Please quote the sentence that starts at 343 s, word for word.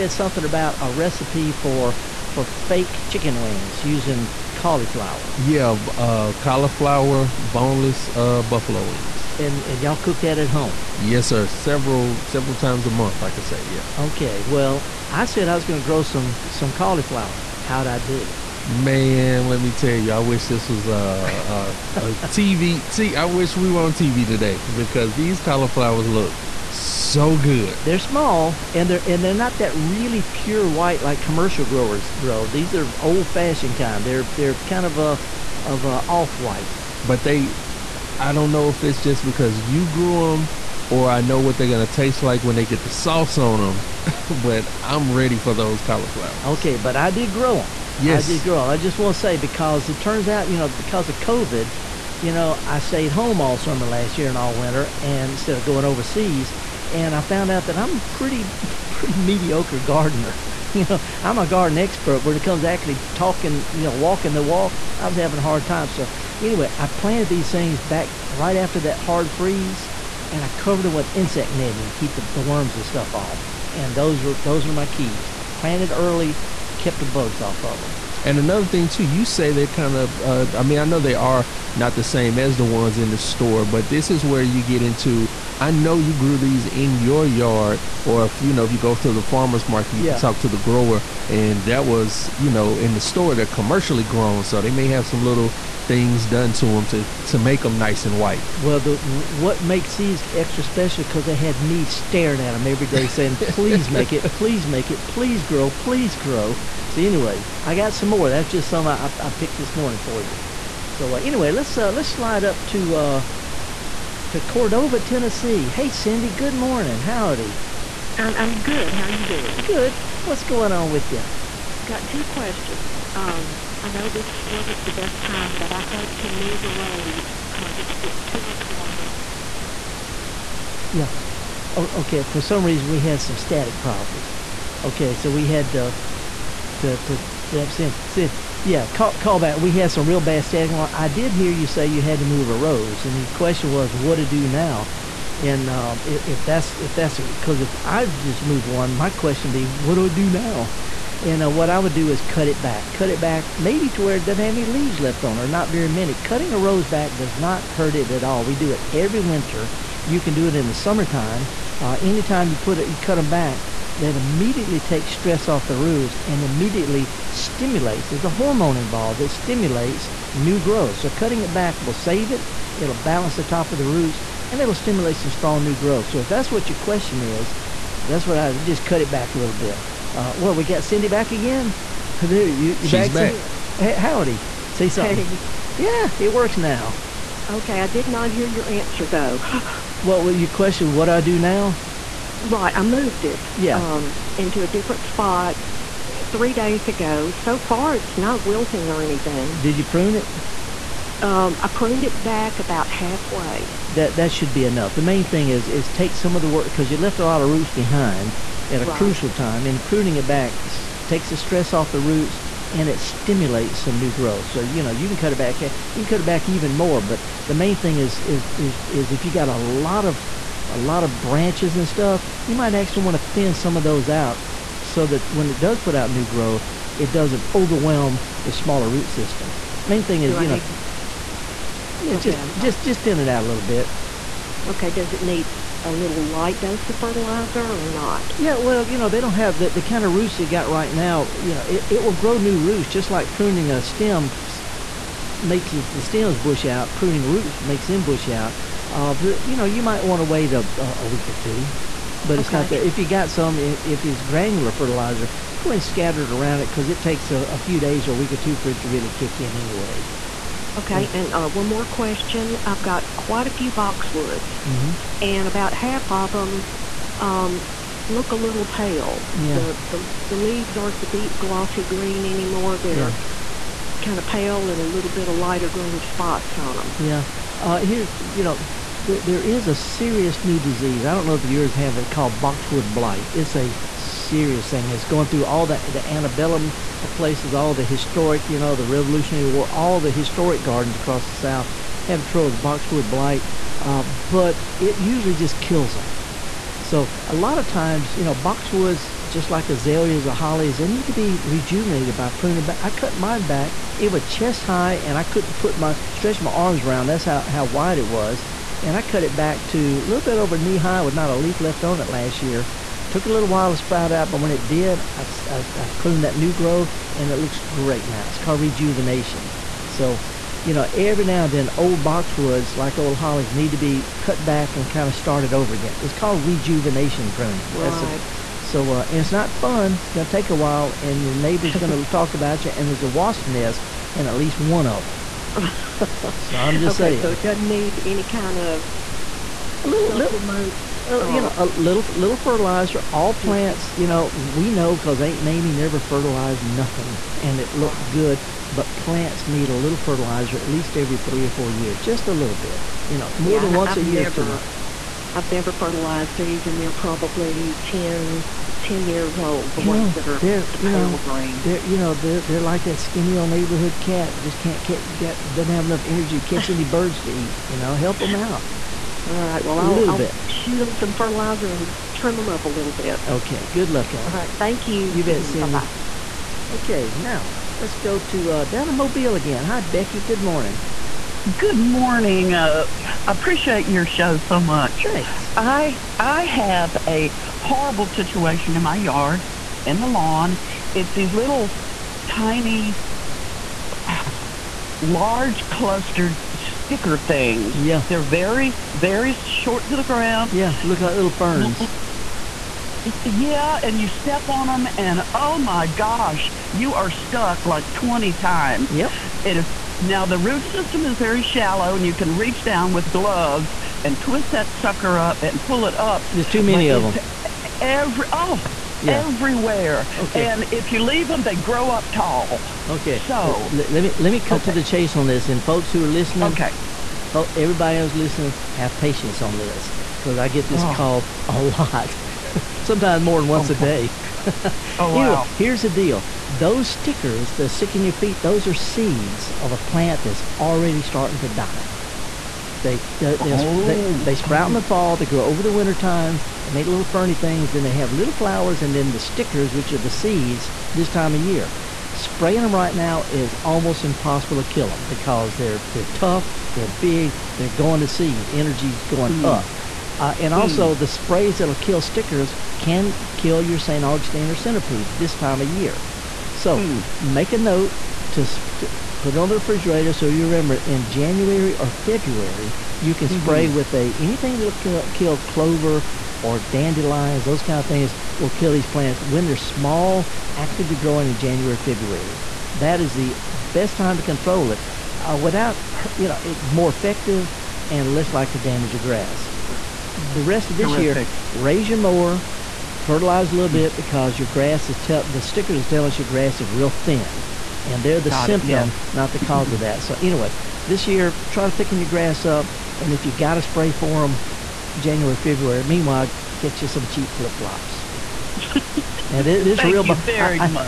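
All plants, you know, we know because Aunt Mamie never fertilized nothing, and it looked right.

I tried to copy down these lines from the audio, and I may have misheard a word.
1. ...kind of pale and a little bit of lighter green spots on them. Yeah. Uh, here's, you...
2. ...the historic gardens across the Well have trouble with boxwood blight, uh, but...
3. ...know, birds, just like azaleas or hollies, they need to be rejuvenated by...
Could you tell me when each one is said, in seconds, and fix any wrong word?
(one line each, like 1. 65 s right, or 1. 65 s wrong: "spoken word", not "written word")
1. 274 s right
2. 289 s wrong: "South", not "Well"
3. 298 s wrong: "boxwoods", not "birds".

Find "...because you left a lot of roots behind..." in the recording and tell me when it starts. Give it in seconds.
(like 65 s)
206 s.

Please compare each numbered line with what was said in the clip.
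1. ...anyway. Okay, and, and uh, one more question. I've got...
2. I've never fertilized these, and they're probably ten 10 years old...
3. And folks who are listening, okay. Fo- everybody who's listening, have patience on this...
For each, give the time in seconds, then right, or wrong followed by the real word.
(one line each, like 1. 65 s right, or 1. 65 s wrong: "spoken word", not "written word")
1. 259 s right
2. 355 s right
3. 425 s right.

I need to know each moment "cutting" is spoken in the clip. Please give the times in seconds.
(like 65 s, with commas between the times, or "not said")
156 s, 171 s.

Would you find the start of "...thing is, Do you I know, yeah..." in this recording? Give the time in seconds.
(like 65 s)
230 s.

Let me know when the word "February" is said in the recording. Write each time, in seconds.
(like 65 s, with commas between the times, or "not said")
471 s, 481 s, 505 s.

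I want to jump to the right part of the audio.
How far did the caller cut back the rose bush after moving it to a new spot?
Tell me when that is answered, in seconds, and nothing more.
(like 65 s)
202 s.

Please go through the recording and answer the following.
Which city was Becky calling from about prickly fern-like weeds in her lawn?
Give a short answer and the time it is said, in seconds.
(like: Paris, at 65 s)
Mobile, at 378 s.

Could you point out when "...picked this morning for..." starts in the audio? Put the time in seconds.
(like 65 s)
109 s.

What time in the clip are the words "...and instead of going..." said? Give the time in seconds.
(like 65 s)
55 s.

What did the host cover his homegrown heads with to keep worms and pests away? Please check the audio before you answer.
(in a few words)
Insect netting.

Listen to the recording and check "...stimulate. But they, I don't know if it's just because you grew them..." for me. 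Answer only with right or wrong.
wrong.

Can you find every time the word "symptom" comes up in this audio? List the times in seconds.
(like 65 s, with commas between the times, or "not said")
498 s.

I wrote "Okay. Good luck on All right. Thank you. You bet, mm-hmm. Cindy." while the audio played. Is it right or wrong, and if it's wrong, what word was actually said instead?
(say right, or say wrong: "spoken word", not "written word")
right.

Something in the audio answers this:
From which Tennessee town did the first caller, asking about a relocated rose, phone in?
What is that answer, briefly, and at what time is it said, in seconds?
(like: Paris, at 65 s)
Cordova, at 114 s.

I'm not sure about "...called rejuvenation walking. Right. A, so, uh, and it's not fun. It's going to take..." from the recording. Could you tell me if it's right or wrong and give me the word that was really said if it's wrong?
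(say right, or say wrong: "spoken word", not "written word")
wrong: "pruning", not "walking".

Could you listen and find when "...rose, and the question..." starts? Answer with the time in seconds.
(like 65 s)
142 s.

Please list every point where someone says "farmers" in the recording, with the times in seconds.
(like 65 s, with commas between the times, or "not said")
89 s.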